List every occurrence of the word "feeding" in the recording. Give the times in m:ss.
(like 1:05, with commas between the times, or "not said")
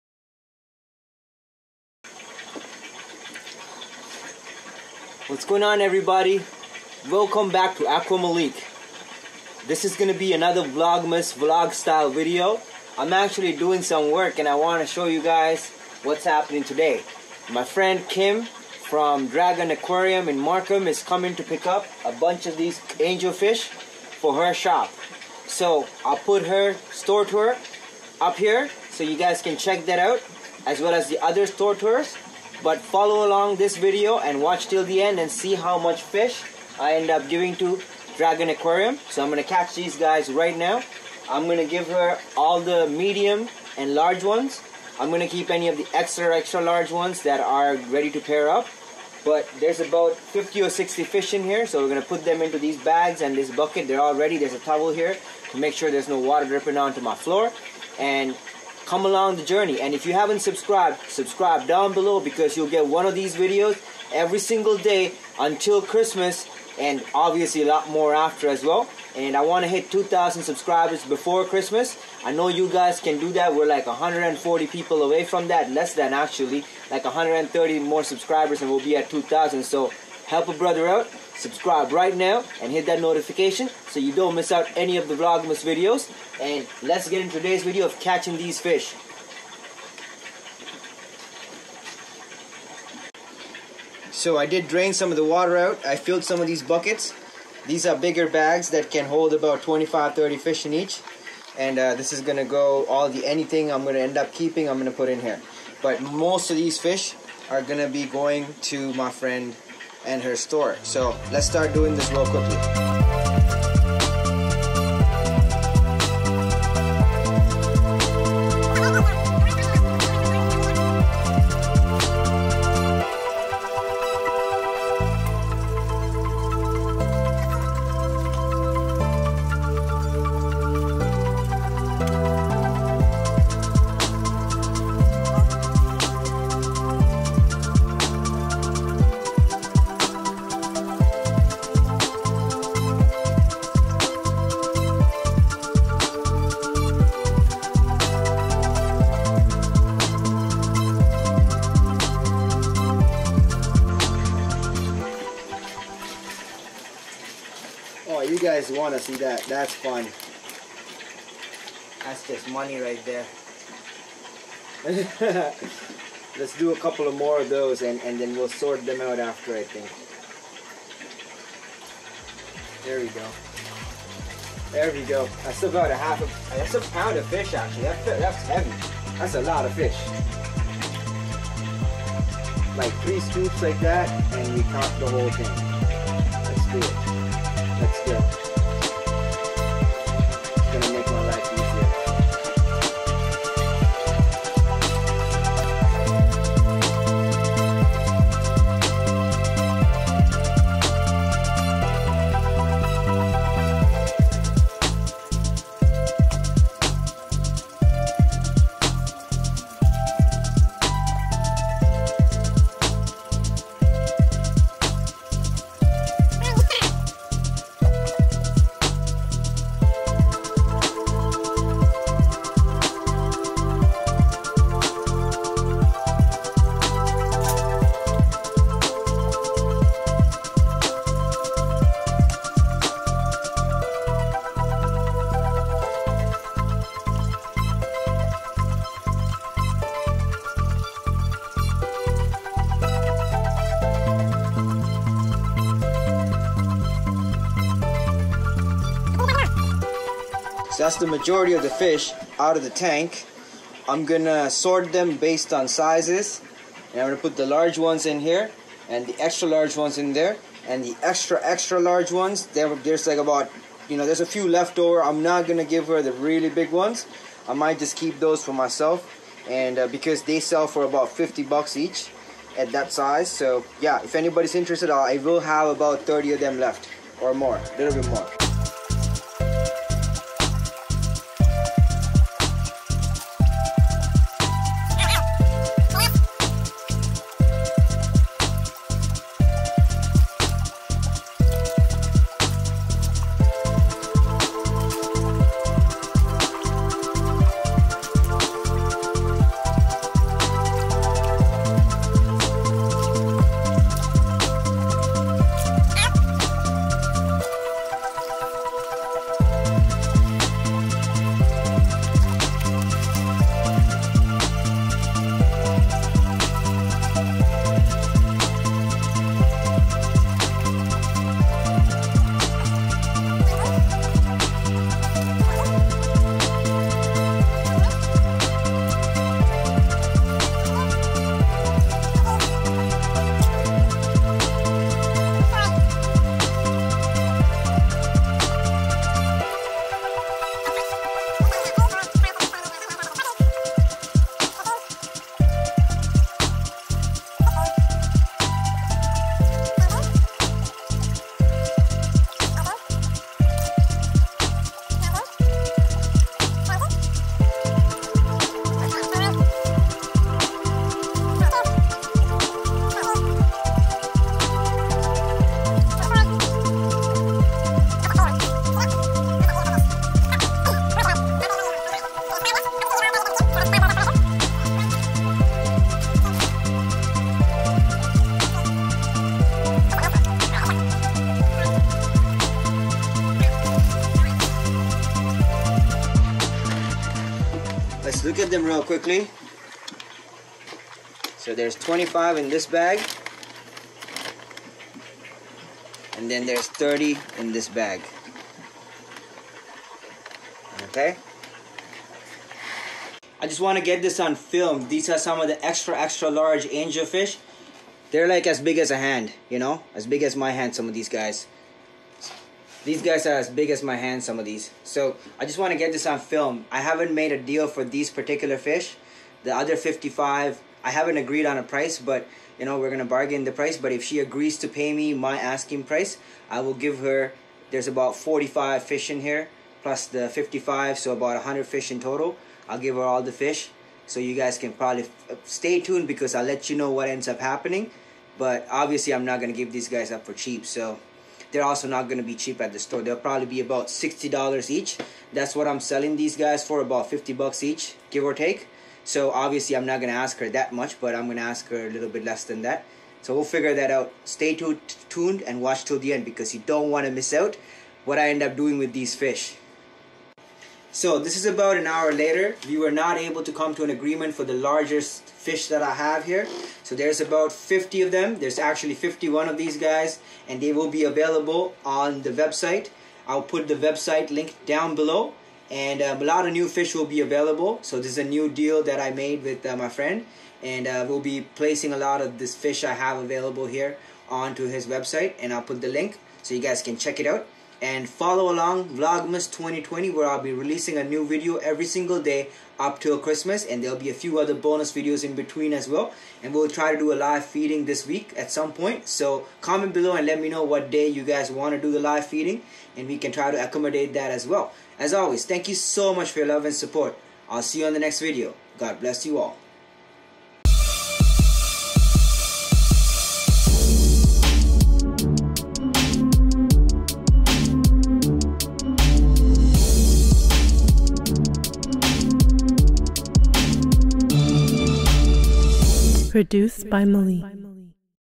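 8:17, 8:22.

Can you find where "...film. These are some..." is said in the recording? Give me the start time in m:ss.
6:44.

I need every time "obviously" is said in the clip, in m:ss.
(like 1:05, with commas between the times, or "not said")
1:07, 7:18, 7:29.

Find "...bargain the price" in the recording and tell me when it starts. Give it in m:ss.
7:03.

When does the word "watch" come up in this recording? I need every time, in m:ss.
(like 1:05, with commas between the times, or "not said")
0:34, 7:35.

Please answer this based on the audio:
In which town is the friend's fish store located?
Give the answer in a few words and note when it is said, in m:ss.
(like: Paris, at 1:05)
Markham, at 0:20.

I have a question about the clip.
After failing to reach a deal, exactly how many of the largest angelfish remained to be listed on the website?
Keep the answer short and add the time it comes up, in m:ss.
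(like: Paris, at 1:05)
51, at 7:48.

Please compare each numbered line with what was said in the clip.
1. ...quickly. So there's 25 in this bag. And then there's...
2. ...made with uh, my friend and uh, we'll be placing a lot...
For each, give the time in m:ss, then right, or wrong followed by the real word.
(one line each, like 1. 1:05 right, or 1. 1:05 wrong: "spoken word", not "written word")
1. 6:28 right
2. 7:59 right.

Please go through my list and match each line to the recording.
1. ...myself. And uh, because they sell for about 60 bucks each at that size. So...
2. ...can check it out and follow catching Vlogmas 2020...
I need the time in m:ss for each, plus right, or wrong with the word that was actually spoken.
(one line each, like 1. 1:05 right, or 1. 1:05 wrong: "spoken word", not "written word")
1. 4:28 wrong: "50", not "60"
2. 8:06 wrong: "along", not "catching".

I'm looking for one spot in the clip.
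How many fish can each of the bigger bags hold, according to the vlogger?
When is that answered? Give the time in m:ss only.
1:39.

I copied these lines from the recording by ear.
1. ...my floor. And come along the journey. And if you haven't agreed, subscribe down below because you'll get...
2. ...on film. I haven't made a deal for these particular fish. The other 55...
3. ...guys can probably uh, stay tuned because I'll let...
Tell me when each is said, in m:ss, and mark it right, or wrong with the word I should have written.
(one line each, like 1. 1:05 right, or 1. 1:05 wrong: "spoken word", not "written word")
1. 0:57 wrong: "subscribed", not "agreed"
2. 6:56 right
3. 7:14 right.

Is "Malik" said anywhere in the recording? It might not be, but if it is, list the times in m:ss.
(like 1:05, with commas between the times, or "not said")
0:08, 8:47.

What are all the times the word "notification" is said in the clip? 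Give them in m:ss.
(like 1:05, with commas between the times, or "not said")
1:23.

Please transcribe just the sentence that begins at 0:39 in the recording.
So I'm going to catch these guys right now.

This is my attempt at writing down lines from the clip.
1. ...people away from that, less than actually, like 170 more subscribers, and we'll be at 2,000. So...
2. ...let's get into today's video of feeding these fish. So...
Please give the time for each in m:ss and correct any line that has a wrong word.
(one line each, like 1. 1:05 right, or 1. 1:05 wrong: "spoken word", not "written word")
1. 1:14 wrong: "130", not "170"
2. 1:26 wrong: "catching", not "feeding".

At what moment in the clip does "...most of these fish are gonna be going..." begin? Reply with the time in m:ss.
1:46.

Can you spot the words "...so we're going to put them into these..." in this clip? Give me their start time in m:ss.
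0:51.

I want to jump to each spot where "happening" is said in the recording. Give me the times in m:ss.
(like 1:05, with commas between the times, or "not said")
0:16, 7:17.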